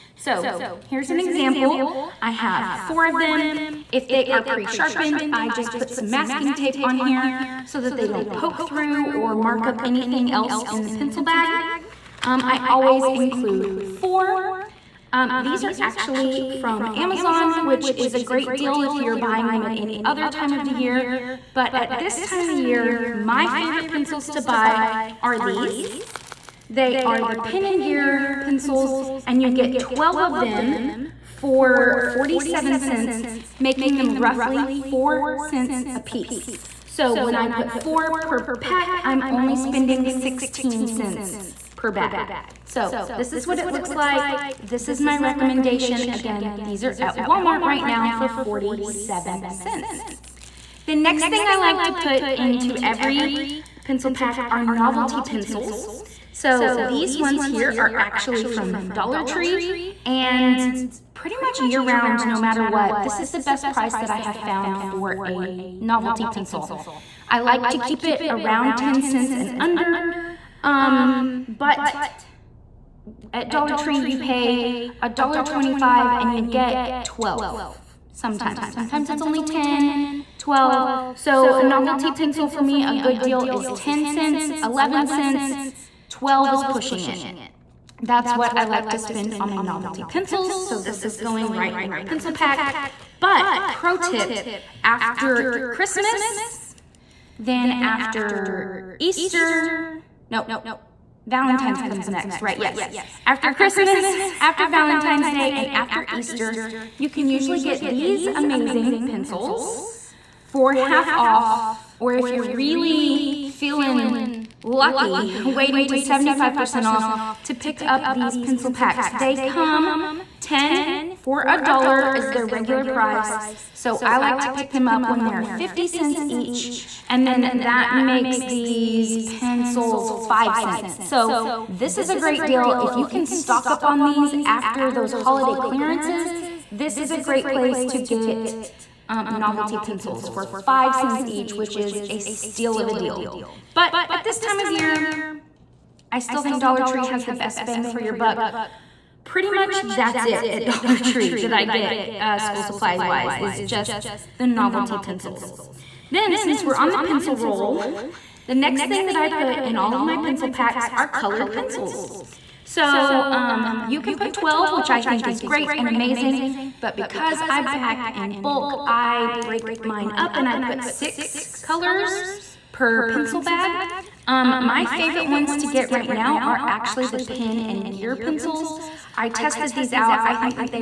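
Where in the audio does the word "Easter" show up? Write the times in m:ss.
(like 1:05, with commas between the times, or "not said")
1:38, 1:46.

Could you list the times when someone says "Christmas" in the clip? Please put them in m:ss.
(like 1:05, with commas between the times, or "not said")
1:35, 1:43.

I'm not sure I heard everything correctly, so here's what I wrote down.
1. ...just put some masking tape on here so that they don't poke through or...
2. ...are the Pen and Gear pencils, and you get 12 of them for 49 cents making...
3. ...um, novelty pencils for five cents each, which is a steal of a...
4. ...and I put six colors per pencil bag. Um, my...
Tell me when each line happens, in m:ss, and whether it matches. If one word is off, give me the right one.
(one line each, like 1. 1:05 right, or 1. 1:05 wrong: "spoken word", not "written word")
1. 0:05 right
2. 0:27 wrong: "47", not "49"
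3. 2:19 right
4. 2:50 right.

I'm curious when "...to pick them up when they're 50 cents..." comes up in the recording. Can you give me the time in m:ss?
2:04.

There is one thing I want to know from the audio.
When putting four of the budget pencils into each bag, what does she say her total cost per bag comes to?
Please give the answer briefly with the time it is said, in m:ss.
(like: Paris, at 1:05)
16 cents, at 0:40.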